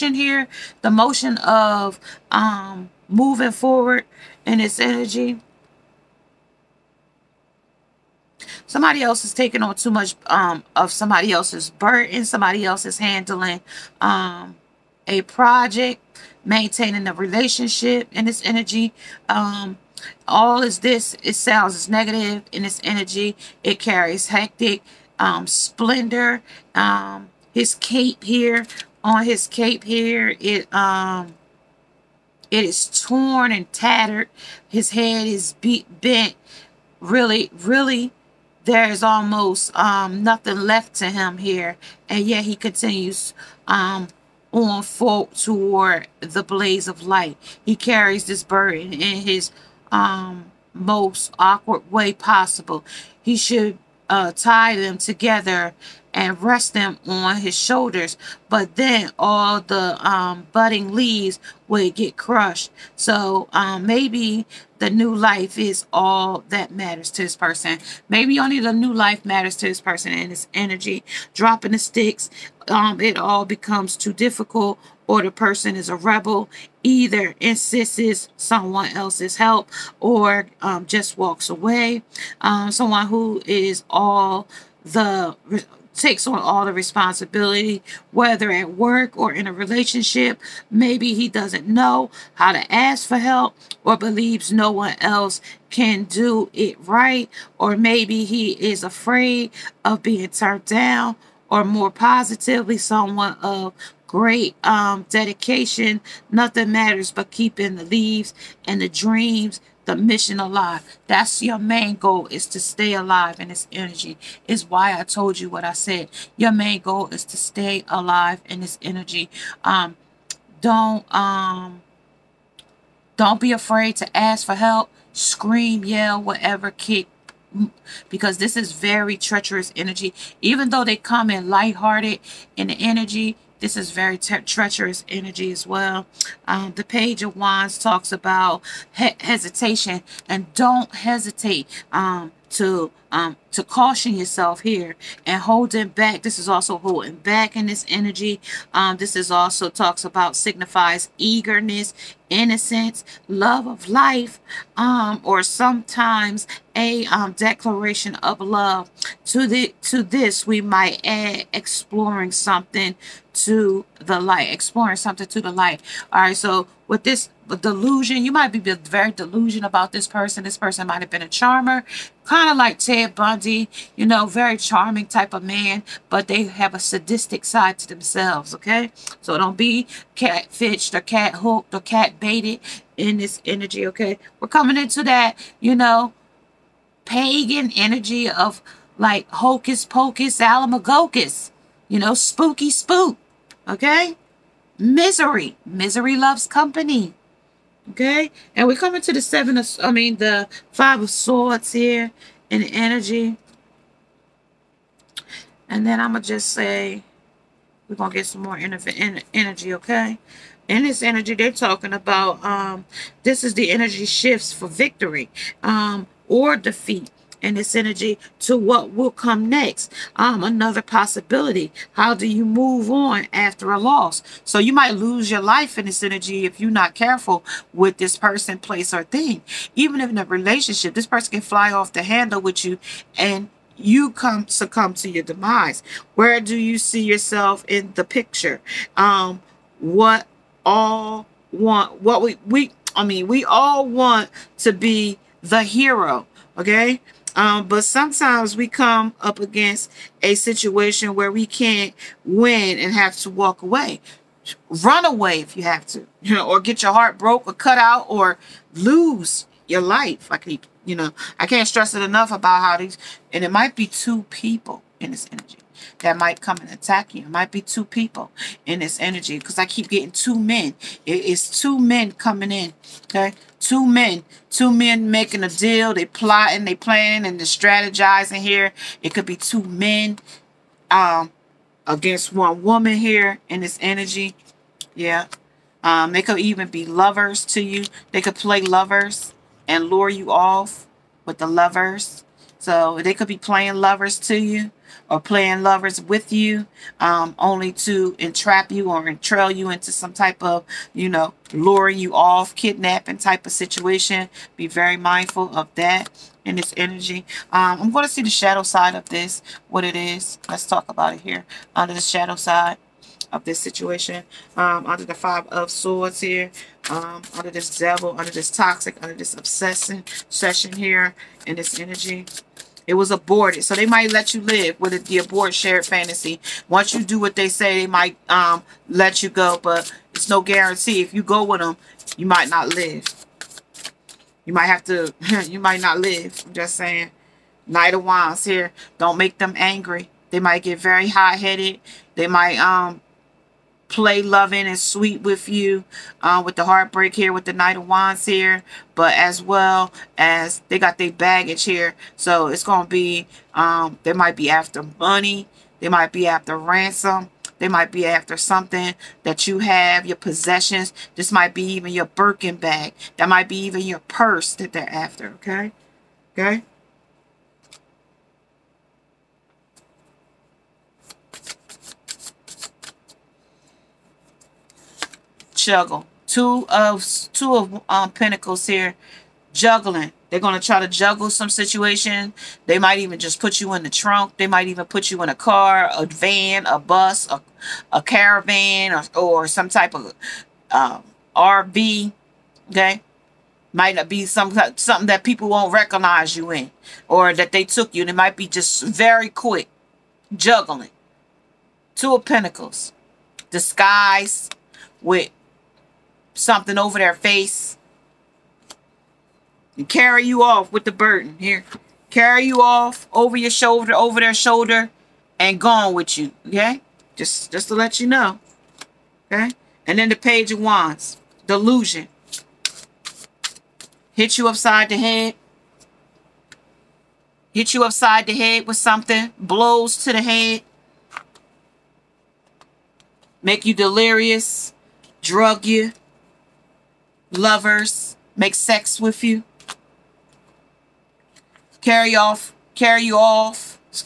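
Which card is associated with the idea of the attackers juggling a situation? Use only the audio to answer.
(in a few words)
Two of Pentacles.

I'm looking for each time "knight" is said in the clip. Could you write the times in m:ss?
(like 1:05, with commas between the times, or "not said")
5:37, 5:47.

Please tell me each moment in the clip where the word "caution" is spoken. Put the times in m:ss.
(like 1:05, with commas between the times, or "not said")
2:23.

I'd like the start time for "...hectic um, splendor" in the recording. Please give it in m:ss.
0:24.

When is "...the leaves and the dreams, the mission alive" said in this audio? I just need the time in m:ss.
1:47.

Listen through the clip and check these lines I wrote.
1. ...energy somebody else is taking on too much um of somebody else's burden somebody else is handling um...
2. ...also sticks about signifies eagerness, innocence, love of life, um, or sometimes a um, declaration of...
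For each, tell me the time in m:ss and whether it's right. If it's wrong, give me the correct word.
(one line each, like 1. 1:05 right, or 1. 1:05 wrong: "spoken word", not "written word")
1. 0:04 right
2. 2:29 wrong: "talks", not "sticks".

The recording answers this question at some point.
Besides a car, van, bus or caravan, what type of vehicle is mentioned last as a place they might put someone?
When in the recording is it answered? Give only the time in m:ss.
6:31.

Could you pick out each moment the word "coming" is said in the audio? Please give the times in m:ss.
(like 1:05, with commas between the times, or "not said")
3:04, 3:18, 4:32.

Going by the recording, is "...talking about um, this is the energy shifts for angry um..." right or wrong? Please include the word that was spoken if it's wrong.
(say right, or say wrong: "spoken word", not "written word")
wrong: "victory", not "angry".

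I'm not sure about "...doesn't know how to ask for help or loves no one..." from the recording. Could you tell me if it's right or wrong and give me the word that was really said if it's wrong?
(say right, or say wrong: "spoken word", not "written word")
wrong: "believes", not "loves".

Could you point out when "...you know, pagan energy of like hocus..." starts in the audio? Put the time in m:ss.
3:05.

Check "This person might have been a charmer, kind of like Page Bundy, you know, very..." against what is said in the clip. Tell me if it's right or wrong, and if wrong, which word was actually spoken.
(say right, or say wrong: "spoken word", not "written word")
wrong: "Ted", not "Page".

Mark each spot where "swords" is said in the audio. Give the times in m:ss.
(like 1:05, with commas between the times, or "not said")
3:21, 5:15.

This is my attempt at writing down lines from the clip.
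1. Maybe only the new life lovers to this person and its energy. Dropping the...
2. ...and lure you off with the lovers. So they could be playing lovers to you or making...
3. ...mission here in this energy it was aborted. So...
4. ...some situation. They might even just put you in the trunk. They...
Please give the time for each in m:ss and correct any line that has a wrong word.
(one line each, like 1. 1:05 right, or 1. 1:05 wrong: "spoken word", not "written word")
1. 1:08 wrong: "matters", not "lovers"
2. 4:49 wrong: "playing", not "making"
3. 5:20 wrong: "session", not "mission"
4. 6:21 right.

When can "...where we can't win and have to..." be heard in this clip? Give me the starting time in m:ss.
4:11.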